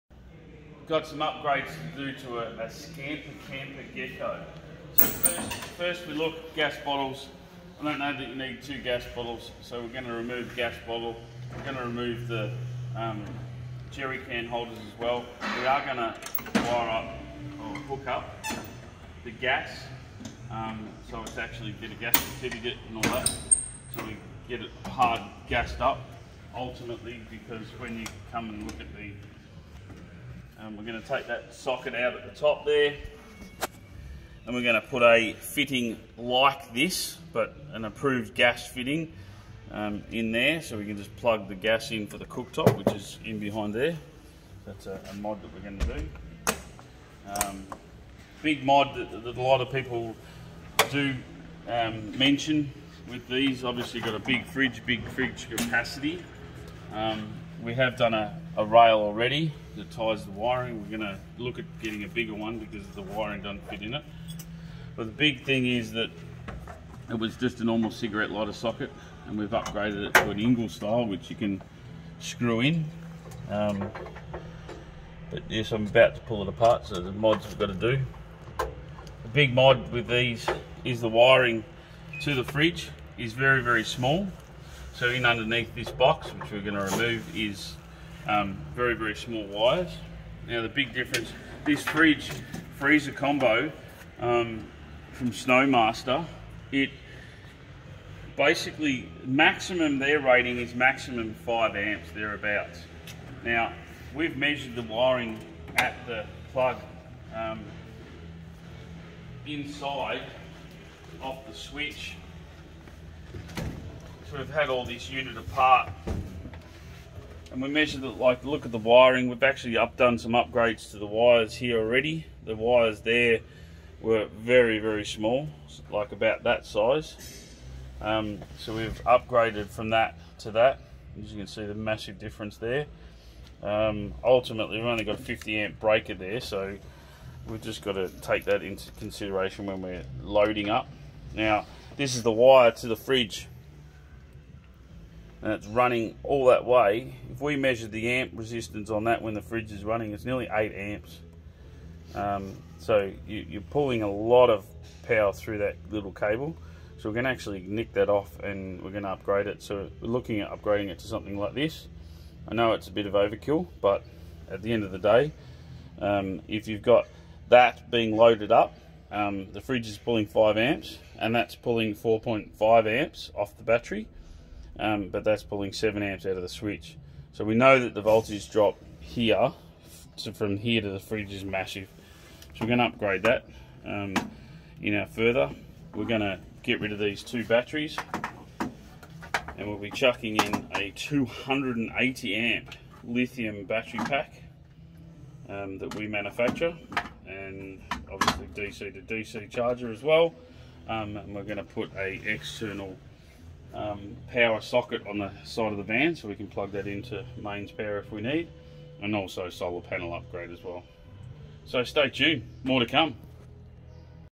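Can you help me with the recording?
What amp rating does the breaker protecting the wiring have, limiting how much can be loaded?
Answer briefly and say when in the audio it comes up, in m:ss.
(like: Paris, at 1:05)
50 amp, at 2:15.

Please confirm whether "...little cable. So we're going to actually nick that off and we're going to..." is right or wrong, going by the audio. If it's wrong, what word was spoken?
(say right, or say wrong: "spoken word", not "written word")
right.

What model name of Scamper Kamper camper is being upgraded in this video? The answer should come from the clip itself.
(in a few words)
Gecko.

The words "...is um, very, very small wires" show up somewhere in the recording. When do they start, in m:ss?
1:27.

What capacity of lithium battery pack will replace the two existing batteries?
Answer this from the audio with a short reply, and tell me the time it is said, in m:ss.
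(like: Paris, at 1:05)
280 amp, at 3:10.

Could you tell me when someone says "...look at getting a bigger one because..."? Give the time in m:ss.
1:01.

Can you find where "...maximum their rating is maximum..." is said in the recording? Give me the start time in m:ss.
1:39.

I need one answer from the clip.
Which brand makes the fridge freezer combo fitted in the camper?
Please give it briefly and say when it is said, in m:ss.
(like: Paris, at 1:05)
SnoMaster, at 1:35.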